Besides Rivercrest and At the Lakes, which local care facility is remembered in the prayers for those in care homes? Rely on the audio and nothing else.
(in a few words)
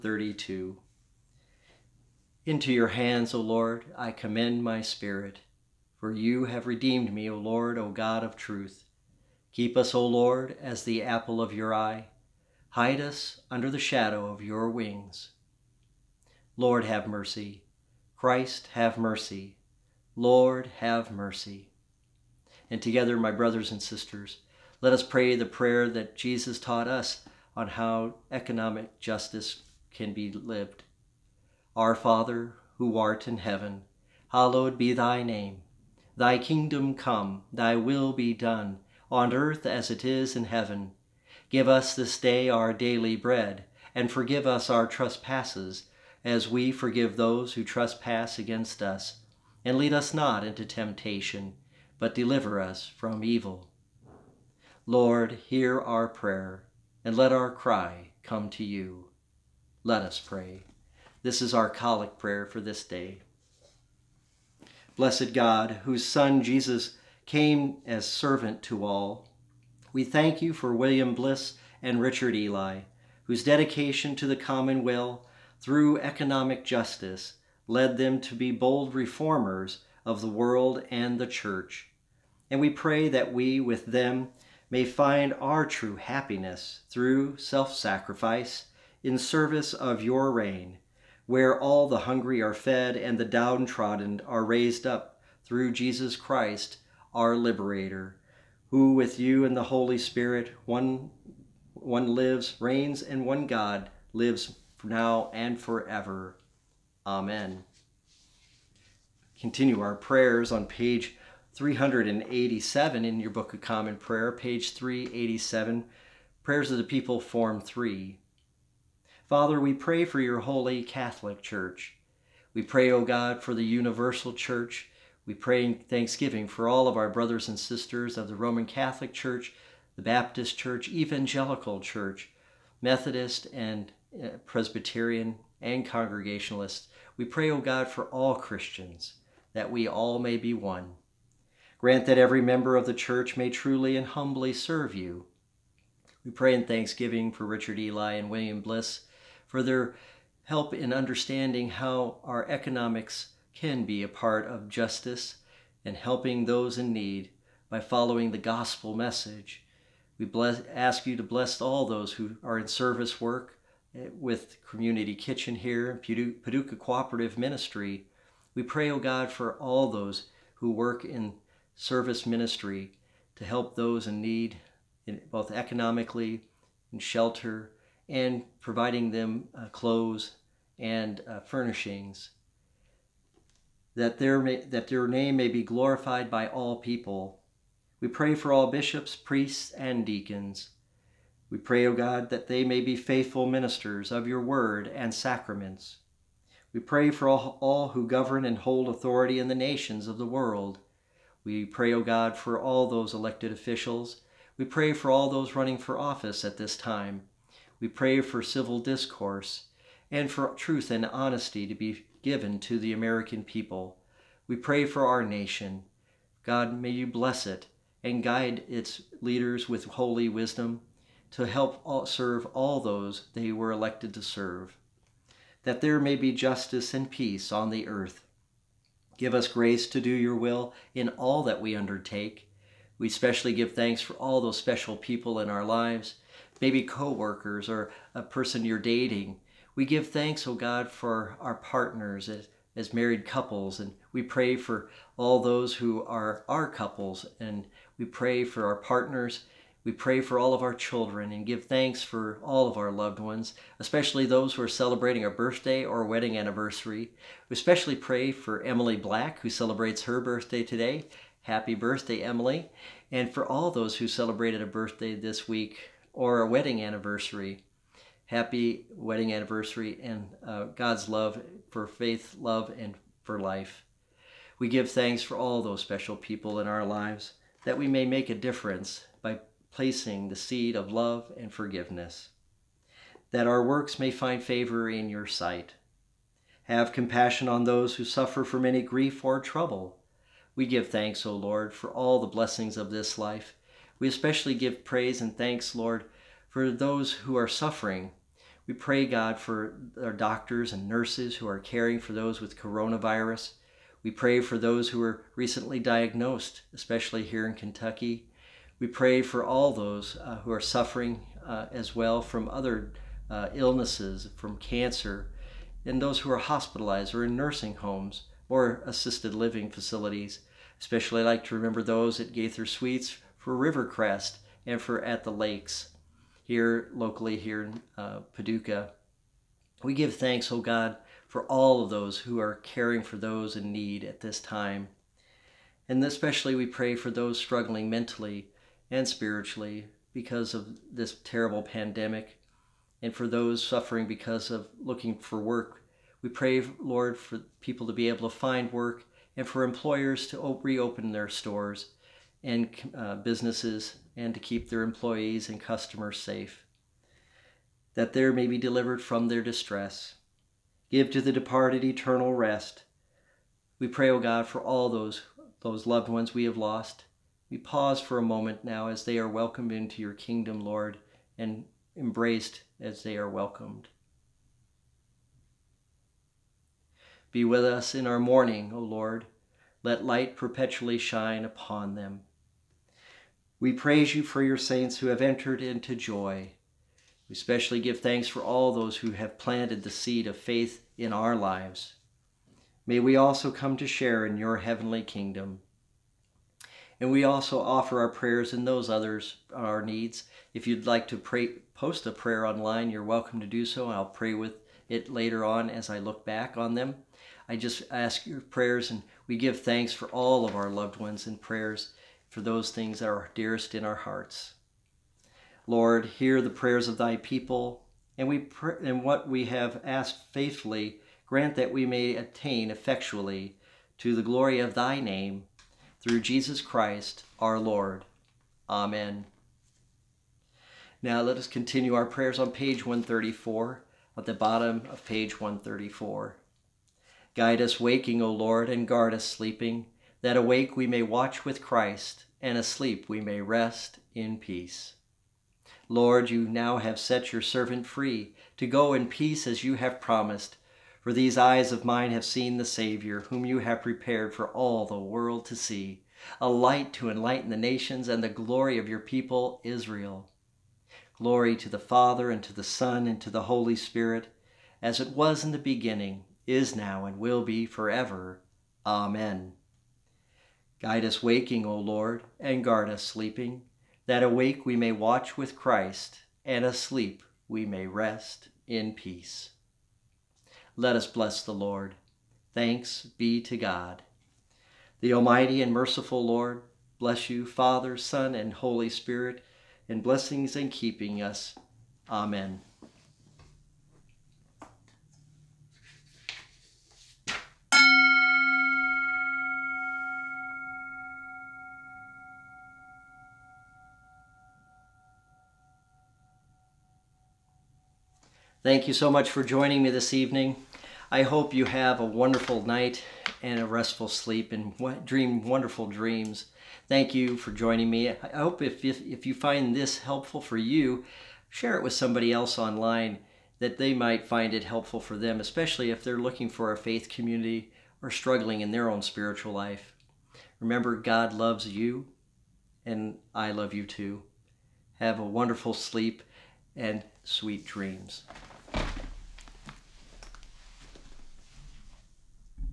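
Gaither Suites.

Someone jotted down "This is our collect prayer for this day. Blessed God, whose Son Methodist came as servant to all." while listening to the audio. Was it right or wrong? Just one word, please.
wrong.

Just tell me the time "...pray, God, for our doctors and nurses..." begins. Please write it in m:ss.
4:58.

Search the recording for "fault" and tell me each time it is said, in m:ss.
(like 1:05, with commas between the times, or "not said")
not said.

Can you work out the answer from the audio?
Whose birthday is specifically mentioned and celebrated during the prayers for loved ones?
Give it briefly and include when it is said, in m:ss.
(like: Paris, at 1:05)
Emily Black, at 4:18.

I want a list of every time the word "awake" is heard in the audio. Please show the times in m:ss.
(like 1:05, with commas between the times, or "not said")
7:20, 7:54.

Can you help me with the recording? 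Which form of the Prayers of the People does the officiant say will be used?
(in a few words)
Form 3.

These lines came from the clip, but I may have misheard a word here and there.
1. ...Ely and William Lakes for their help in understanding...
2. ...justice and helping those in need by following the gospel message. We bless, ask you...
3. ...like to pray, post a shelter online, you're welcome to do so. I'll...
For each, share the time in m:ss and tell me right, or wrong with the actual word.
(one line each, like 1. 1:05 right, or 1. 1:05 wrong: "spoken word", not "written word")
1. 2:27 wrong: "Bliss", not "Lakes"
2. 2:34 right
3. 6:40 wrong: "prayer", not "shelter".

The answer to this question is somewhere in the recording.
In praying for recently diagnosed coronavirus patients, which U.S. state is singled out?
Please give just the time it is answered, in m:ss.
5:07.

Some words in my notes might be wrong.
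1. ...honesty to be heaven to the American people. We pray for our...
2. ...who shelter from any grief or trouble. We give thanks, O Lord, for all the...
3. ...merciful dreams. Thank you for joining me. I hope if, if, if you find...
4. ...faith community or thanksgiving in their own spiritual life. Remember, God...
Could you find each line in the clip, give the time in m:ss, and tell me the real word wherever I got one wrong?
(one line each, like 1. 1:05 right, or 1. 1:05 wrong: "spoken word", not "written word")
1. 3:31 wrong: "given", not "heaven"
2. 4:47 wrong: "suffer", not "shelter"
3. 8:35 wrong: "wonderful", not "merciful"
4. 8:46 wrong: "struggling", not "thanksgiving".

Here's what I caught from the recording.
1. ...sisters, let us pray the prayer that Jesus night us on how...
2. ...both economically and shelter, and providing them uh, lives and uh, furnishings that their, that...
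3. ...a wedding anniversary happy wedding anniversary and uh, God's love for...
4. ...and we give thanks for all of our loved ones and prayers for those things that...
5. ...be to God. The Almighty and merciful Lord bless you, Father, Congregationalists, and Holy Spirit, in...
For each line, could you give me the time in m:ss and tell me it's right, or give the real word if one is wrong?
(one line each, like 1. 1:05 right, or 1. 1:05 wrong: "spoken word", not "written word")
1. 0:23 wrong: "taught", not "night"
2. 2:55 wrong: "clothes", not "lives"
3. 4:26 right
4. 6:48 right
5. 8:03 wrong: "Son", not "Congregationalists".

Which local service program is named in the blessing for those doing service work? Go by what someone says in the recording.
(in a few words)
Community Kitchen.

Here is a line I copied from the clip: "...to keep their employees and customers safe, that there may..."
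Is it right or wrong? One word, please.
right.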